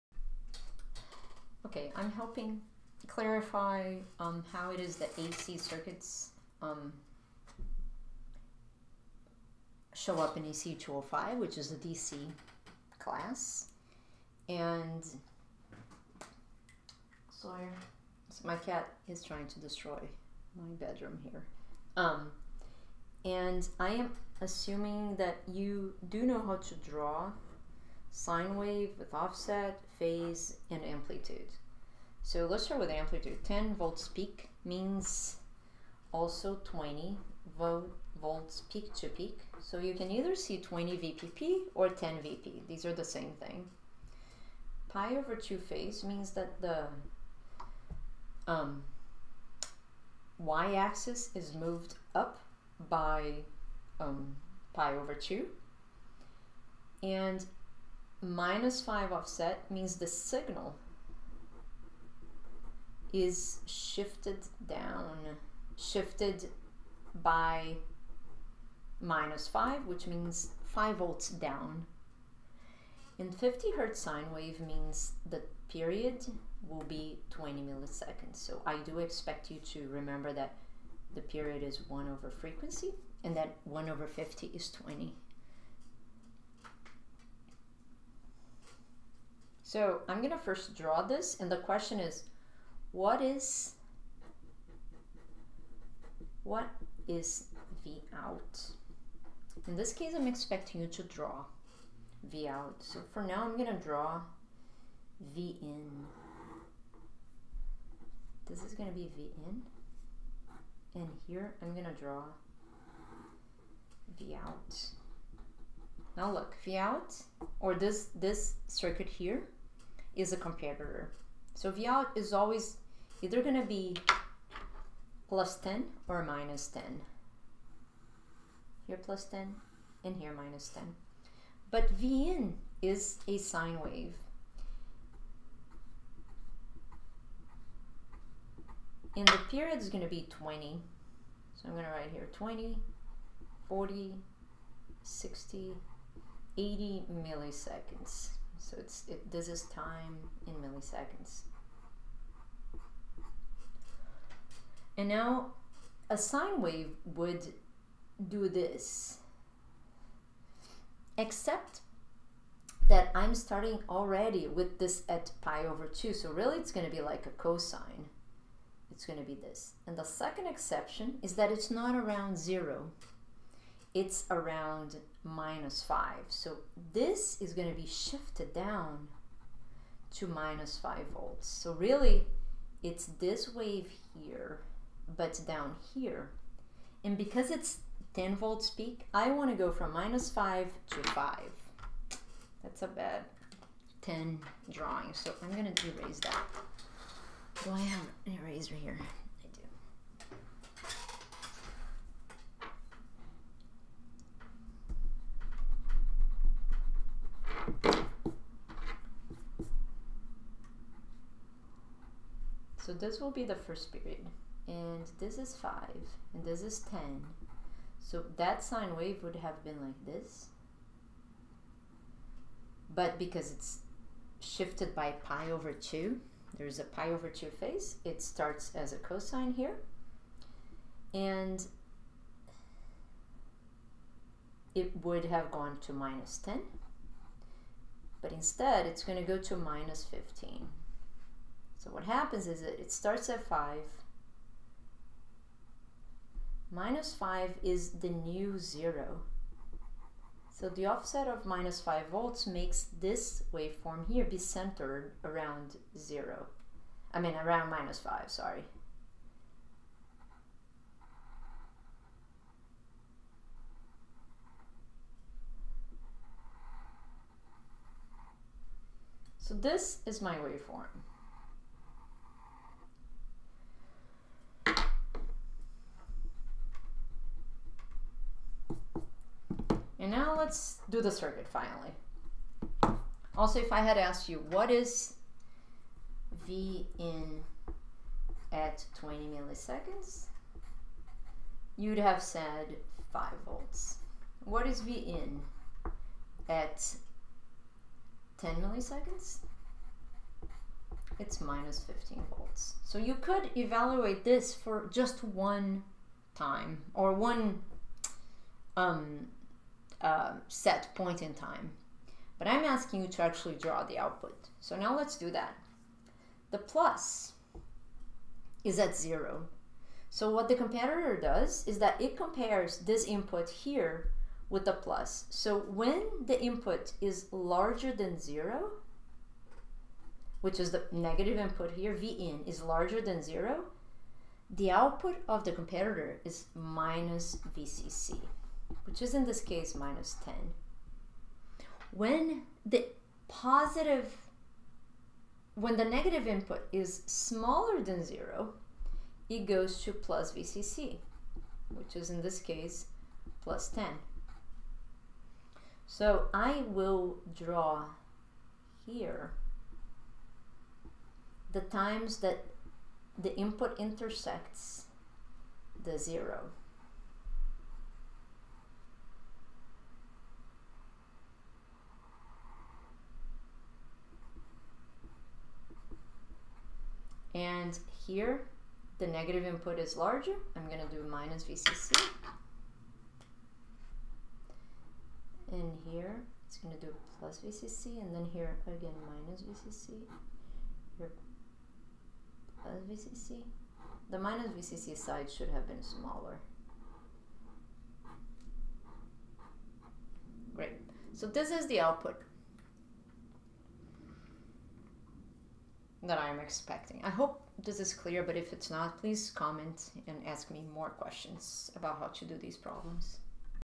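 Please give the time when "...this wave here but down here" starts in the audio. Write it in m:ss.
3:03.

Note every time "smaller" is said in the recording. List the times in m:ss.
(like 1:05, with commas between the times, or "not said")
5:47, 6:35.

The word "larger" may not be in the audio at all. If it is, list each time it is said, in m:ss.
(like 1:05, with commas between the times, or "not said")
5:27, 5:32, 6:19.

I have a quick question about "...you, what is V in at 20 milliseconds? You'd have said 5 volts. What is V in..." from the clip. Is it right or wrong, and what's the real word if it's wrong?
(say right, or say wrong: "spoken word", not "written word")
right.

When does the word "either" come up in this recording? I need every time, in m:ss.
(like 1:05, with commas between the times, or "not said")
0:40, 2:03.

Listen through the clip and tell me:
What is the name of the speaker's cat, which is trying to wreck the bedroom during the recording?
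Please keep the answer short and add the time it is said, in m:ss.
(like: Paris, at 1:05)
Sawyer, at 0:17.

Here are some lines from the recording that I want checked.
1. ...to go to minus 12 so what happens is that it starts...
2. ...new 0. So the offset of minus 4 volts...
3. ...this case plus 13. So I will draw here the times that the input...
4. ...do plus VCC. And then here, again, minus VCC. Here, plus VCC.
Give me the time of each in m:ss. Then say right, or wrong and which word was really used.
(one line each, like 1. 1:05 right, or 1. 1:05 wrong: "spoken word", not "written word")
1. 3:59 wrong: "15", not "12"
2. 4:08 wrong: "5", not "4"
3. 5:52 wrong: "10", not "13"
4. 6:26 right.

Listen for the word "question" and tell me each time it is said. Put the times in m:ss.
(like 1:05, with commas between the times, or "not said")
1:31, 6:50.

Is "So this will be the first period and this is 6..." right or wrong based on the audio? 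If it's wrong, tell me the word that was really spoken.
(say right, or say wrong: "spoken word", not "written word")
wrong: "5", not "6".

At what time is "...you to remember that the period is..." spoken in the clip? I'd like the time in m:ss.
1:19.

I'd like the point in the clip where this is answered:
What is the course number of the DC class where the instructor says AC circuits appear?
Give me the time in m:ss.
0:10.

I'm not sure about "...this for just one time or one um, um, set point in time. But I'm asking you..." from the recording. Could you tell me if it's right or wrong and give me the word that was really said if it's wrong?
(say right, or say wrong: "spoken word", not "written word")
right.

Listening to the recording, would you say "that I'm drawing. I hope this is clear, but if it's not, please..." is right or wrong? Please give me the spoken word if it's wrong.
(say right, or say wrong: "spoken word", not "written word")
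wrong: "expecting", not "drawing".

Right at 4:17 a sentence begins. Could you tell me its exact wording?
I mean around minus 5, sorry.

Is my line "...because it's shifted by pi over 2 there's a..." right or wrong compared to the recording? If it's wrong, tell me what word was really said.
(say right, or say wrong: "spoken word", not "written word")
right.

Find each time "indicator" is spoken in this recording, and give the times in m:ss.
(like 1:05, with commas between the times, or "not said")
not said.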